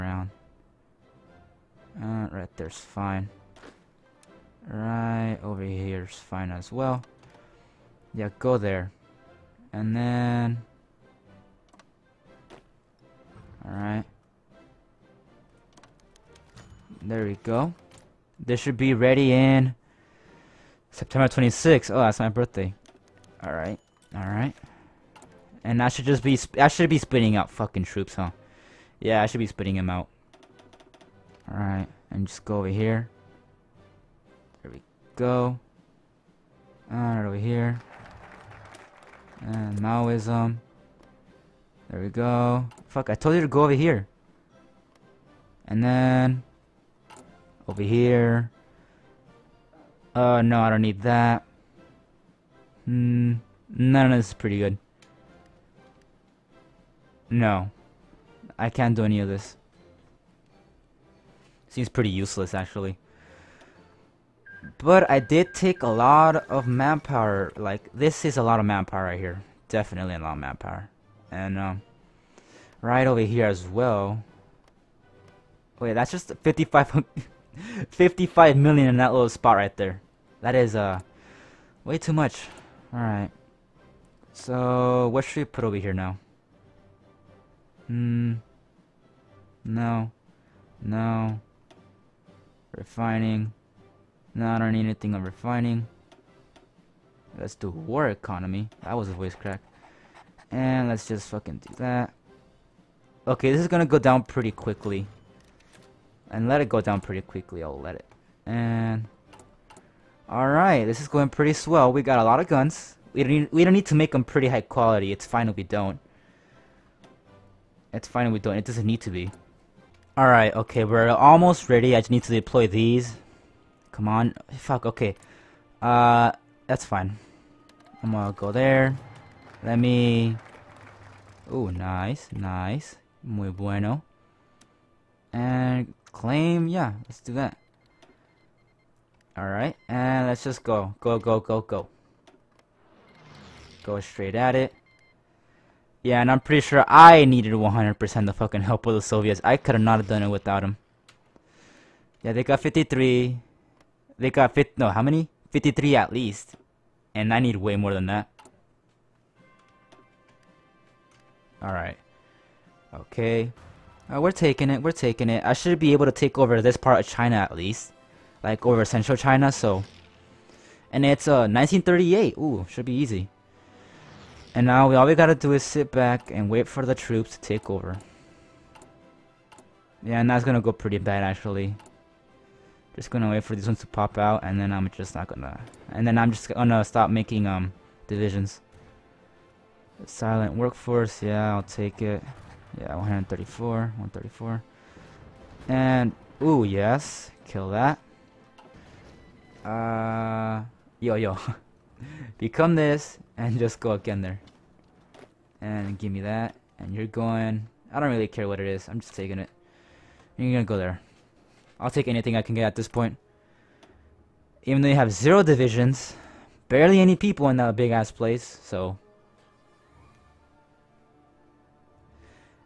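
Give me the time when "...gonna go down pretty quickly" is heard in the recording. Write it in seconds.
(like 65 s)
103 s.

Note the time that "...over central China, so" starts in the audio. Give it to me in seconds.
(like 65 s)
168 s.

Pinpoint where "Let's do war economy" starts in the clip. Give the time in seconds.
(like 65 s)
97 s.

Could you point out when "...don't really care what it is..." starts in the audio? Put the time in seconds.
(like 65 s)
207 s.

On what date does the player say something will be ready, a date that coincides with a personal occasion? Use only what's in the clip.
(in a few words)
September 26th.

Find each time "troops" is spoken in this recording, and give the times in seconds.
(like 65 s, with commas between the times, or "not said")
27 s, 176 s.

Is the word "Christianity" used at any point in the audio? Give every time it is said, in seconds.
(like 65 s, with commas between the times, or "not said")
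not said.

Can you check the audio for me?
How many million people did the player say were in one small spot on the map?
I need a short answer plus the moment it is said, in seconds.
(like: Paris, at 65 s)
55, at 77 s.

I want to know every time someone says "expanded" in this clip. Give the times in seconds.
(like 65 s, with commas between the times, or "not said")
not said.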